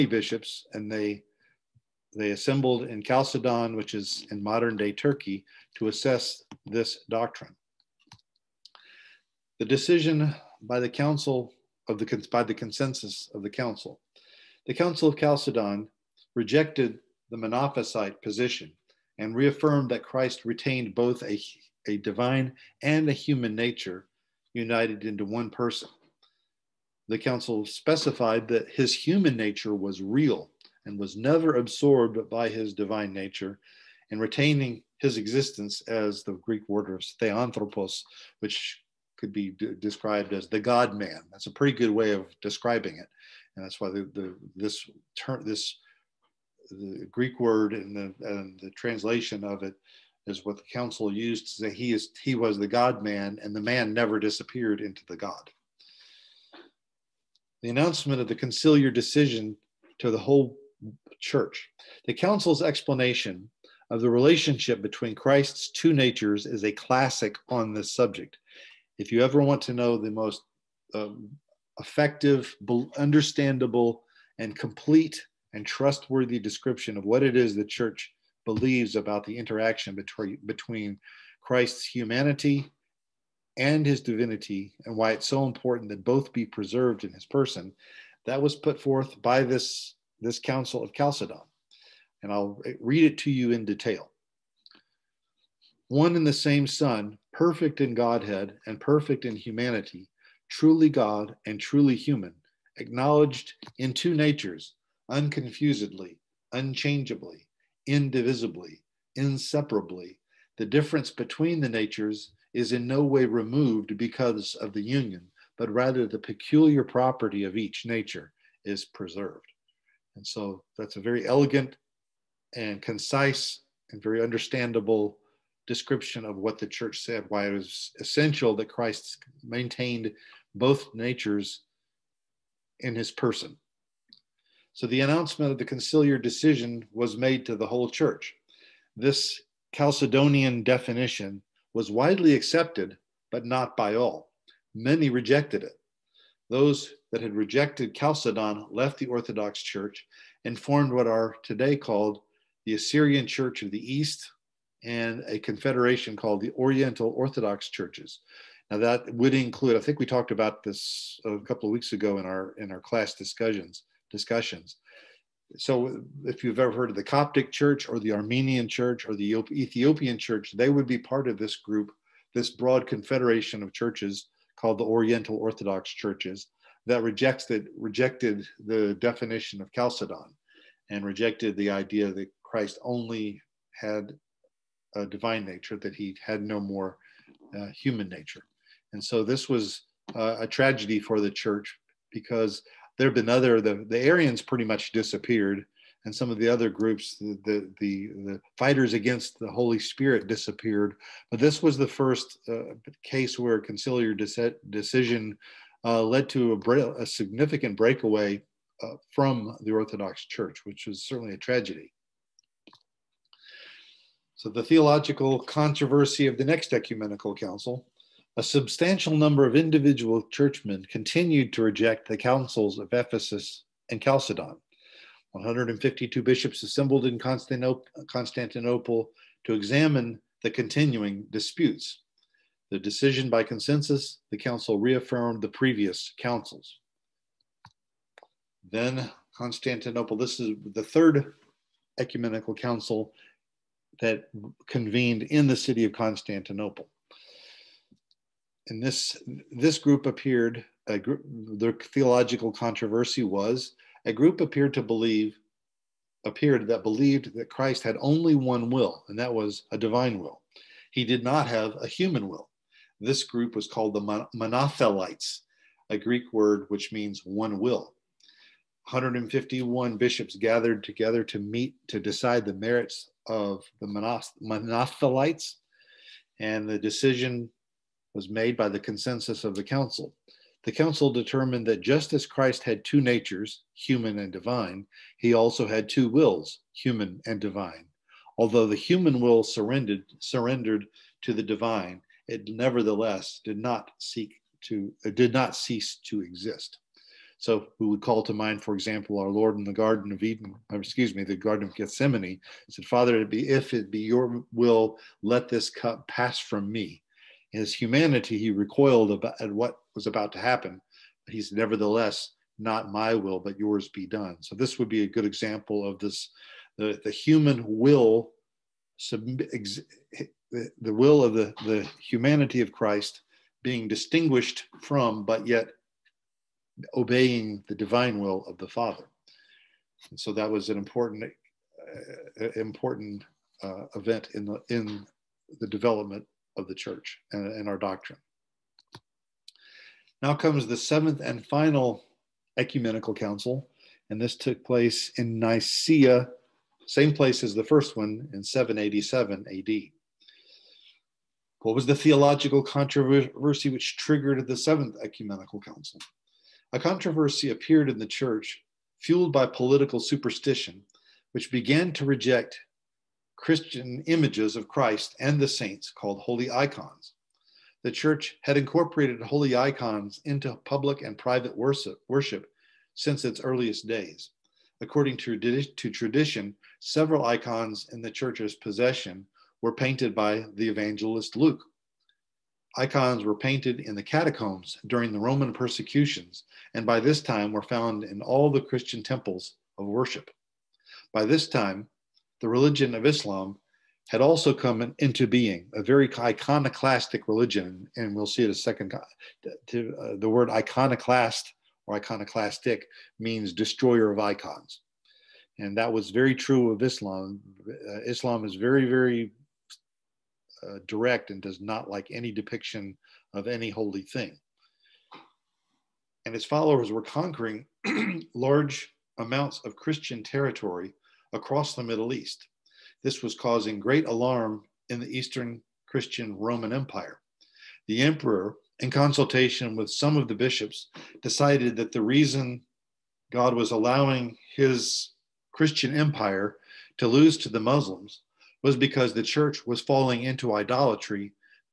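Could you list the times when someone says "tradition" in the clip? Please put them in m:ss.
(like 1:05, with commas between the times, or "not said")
6:15.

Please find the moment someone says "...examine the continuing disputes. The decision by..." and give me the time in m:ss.
3:49.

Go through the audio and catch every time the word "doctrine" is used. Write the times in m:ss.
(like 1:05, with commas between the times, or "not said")
0:07, 5:37.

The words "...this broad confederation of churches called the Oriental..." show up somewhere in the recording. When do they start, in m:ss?
2:52.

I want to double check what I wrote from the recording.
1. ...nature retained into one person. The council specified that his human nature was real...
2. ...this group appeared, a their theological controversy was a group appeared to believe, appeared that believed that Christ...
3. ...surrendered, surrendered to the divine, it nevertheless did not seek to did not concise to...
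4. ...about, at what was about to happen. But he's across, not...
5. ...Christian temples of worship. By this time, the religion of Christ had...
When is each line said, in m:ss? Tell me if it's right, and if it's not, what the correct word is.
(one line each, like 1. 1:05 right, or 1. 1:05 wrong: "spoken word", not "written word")
1. 0:23 wrong: "united", not "retained"
2. 4:09 right
3. 4:49 wrong: "cease", not "concise"
4. 5:09 wrong: "nevertheless", not "across"
5. 6:28 wrong: "Islam", not "Christ".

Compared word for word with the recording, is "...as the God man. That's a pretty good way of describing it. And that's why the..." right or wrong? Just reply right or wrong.
right.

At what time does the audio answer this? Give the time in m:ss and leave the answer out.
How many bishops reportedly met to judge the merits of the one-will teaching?
4:28.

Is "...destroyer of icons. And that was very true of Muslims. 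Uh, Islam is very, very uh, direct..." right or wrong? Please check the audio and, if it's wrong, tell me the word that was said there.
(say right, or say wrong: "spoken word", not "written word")
wrong: "Islam", not "Muslims".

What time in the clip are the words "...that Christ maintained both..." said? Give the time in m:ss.
2:08.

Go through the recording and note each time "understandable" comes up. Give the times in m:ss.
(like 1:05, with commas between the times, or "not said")
1:12, 2:04.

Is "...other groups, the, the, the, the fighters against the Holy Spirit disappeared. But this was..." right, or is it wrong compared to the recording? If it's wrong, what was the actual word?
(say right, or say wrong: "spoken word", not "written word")
right.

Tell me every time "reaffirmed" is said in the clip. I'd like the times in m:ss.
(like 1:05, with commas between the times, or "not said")
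0:19, 3:54.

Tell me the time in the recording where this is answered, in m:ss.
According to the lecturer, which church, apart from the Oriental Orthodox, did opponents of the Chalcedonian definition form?
2:32.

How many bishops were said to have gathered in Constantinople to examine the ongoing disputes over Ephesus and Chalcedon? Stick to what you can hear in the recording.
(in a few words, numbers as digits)
152.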